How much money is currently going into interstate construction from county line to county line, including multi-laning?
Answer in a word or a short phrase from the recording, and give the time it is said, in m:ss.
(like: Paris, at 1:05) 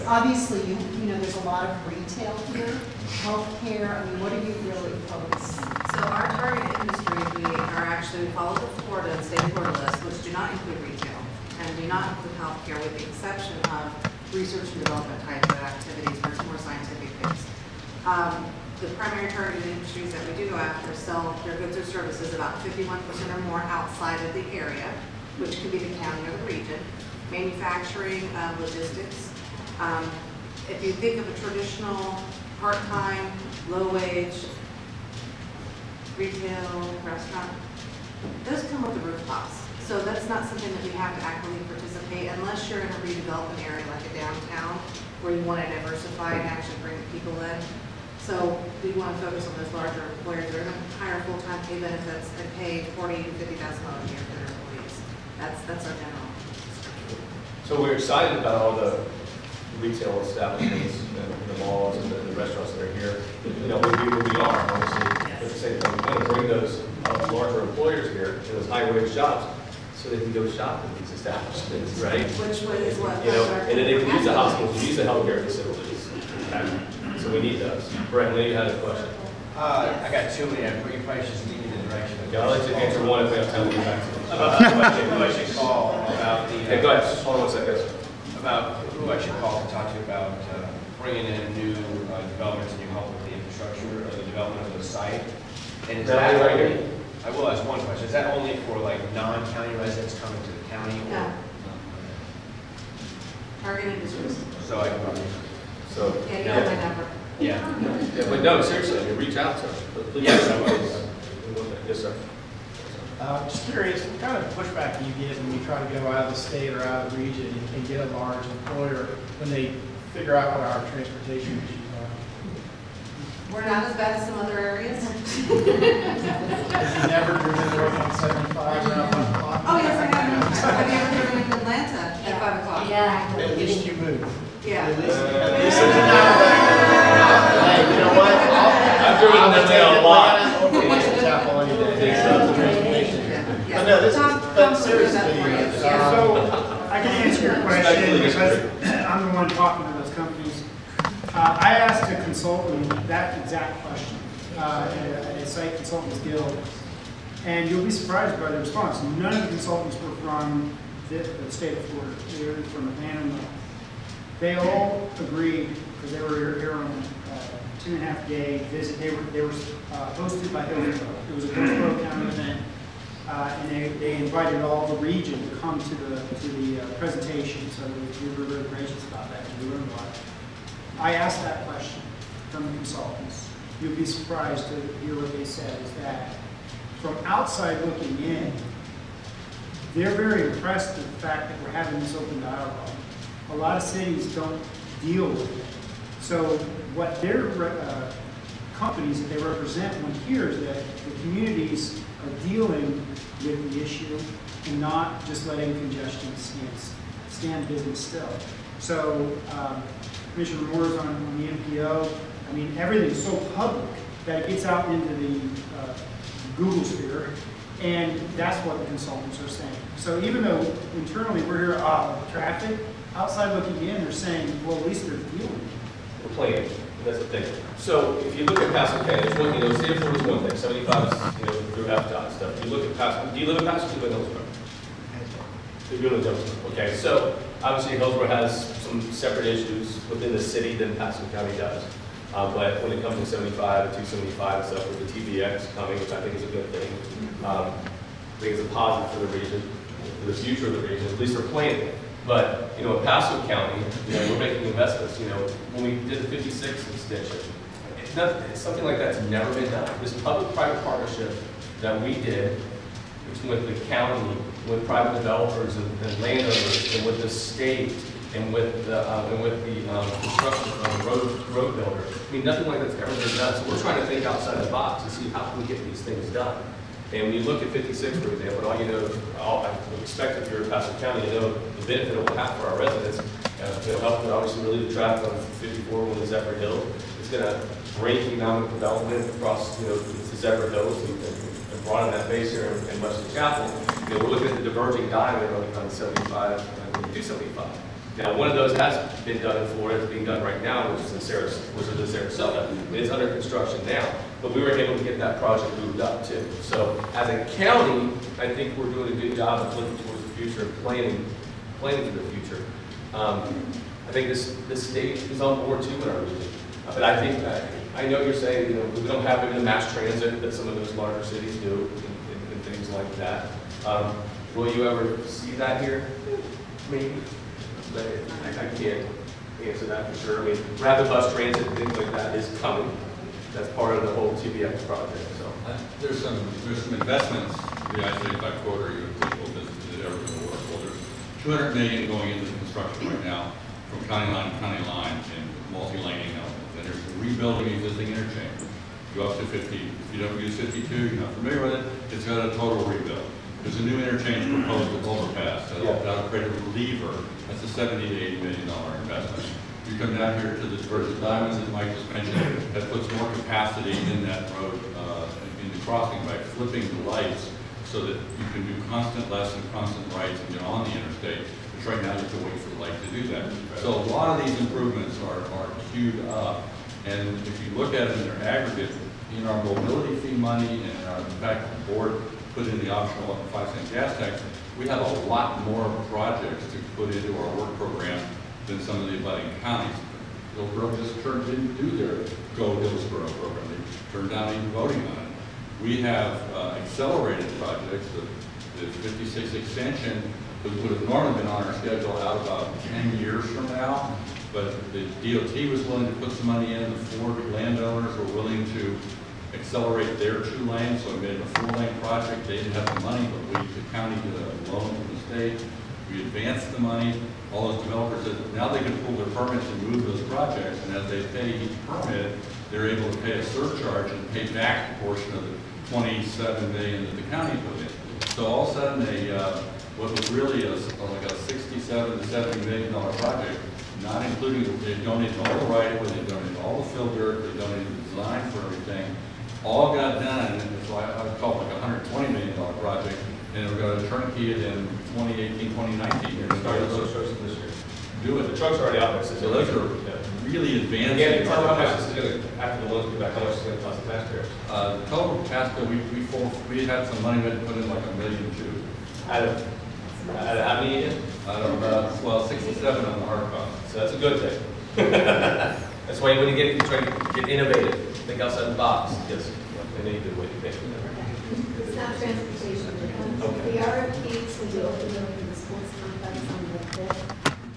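200 million, at 5:41.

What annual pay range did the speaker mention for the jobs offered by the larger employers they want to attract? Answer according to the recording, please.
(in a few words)
40,000 to 50,000 dollars.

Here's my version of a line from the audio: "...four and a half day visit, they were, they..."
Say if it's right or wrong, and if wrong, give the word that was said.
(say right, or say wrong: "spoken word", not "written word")
wrong: "two", not "four".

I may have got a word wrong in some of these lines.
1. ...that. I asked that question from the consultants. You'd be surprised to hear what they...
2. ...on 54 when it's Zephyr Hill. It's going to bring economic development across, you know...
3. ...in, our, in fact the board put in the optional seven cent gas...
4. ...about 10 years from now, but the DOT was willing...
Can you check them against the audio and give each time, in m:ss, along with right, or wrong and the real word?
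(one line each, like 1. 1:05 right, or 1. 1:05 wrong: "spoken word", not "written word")
1. 2:59 right
2. 4:45 right
3. 6:20 wrong: "five", not "seven"
4. 6:42 right.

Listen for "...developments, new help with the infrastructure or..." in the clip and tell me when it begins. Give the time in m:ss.
1:32.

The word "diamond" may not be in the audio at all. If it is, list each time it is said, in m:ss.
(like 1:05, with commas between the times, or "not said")
4:55, 6:01.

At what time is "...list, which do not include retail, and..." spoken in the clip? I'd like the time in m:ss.
0:09.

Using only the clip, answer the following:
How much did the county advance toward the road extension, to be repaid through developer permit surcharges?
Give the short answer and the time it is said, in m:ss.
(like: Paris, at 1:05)
27 million, at 7:05.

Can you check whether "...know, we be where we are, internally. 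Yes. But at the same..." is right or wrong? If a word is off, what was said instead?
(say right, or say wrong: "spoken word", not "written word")
wrong: "obviously", not "internally".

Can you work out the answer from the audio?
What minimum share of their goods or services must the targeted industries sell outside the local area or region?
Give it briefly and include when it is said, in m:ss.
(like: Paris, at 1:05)
51%, at 0:22.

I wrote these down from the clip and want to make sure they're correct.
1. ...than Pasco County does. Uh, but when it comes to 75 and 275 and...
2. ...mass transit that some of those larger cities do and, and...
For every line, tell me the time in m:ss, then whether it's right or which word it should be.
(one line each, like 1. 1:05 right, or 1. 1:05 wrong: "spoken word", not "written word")
1. 4:00 right
2. 5:19 right.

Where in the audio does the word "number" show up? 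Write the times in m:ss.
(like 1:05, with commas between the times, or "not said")
1:46.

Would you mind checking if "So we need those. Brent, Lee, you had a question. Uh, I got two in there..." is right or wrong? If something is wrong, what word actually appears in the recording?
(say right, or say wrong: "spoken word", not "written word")
right.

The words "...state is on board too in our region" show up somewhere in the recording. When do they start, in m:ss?
5:14.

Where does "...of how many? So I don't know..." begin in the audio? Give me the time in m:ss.
7:40.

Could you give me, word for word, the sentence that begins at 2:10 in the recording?
Have you ever driven in Atlanta at 5 o'clock.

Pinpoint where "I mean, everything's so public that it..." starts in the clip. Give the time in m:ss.
3:32.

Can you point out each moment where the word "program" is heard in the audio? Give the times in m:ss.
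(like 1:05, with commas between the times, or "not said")
6:27, 6:33.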